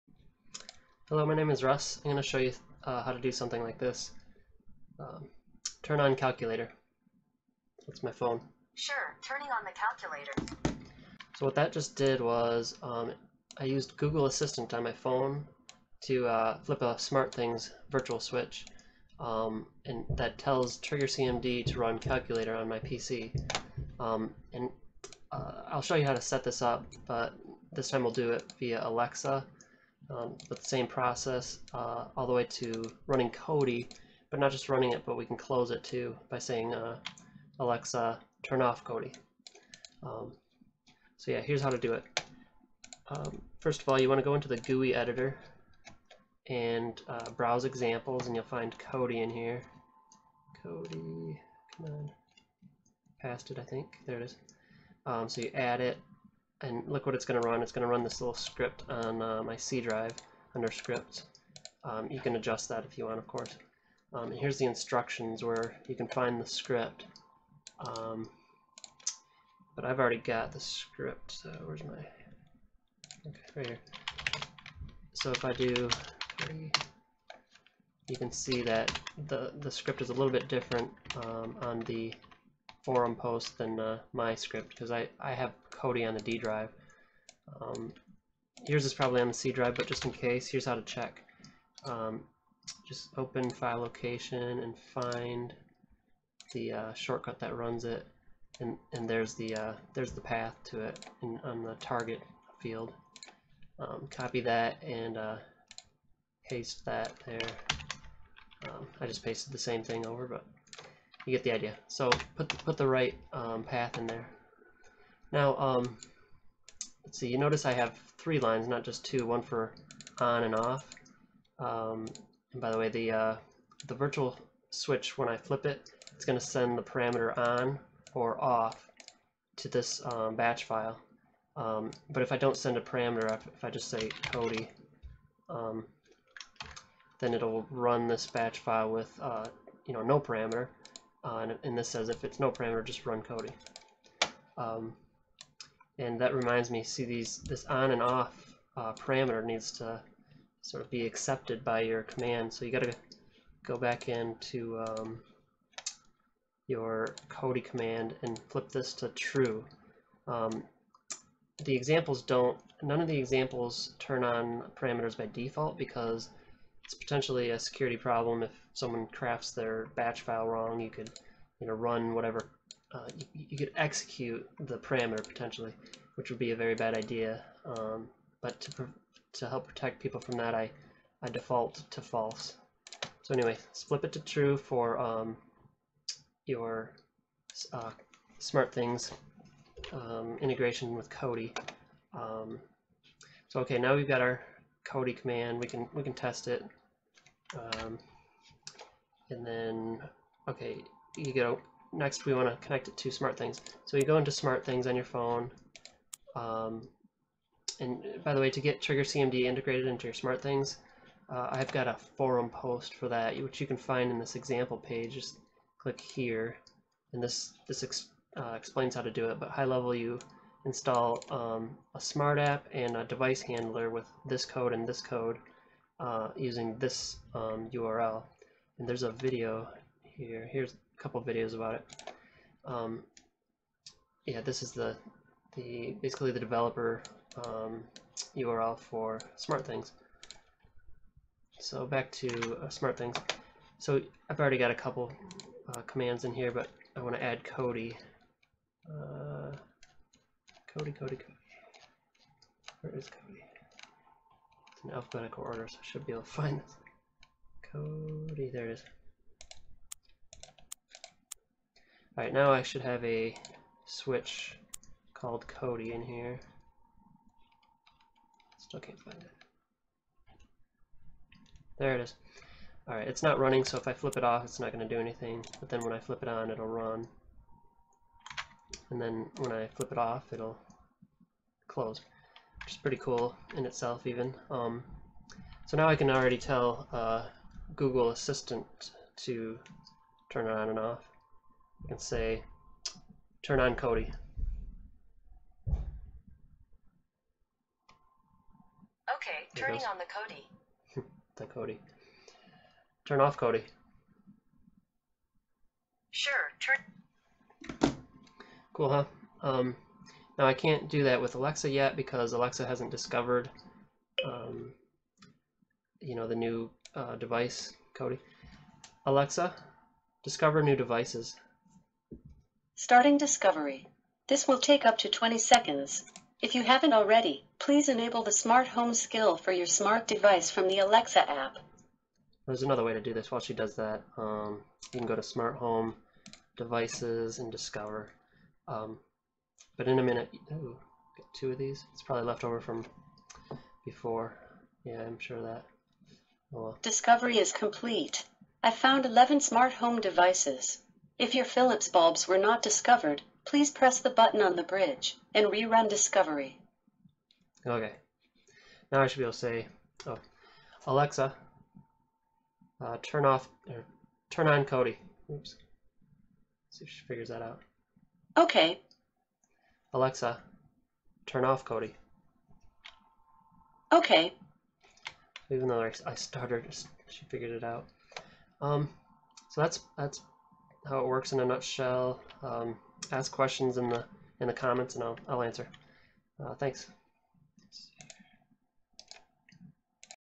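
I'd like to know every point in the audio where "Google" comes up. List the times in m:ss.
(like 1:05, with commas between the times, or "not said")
0:13, 4:47.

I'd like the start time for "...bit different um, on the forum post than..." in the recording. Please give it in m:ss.
1:20.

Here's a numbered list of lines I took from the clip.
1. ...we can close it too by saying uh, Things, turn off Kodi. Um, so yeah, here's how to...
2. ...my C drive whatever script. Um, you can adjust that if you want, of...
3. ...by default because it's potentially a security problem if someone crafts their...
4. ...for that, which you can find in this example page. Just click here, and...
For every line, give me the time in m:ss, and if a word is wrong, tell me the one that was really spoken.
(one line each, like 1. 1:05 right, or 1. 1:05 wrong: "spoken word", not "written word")
1. 0:35 wrong: "Alexa", not "Things"
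2. 0:59 wrong: "under", not "whatever"
3. 2:45 right
4. 3:32 right.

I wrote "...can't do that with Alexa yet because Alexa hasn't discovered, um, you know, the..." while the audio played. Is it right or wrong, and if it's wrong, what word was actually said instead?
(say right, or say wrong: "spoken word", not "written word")
right.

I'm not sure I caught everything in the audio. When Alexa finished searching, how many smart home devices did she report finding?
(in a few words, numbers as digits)
11.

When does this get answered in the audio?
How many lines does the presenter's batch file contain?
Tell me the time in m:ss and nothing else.
1:58.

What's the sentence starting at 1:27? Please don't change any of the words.
Um, yours is probably on the C drive, but just in case, here's how to check.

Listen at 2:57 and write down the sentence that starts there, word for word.
Um, but to, to help protect people from that, I, I default to false.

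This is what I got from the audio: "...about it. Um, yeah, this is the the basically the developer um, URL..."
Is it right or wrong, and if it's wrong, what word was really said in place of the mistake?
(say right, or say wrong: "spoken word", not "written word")
right.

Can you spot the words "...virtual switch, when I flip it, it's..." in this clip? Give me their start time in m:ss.
2:03.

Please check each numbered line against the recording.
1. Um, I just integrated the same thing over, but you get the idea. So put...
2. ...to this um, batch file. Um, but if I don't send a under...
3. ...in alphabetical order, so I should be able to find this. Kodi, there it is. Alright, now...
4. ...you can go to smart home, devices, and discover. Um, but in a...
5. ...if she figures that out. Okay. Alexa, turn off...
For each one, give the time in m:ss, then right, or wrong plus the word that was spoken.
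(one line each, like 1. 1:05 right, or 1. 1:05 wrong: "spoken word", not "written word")
1. 1:48 wrong: "pasted", not "integrated"
2. 2:09 wrong: "parameter", not "under"
3. 4:14 right
4. 5:34 right
5. 6:06 right.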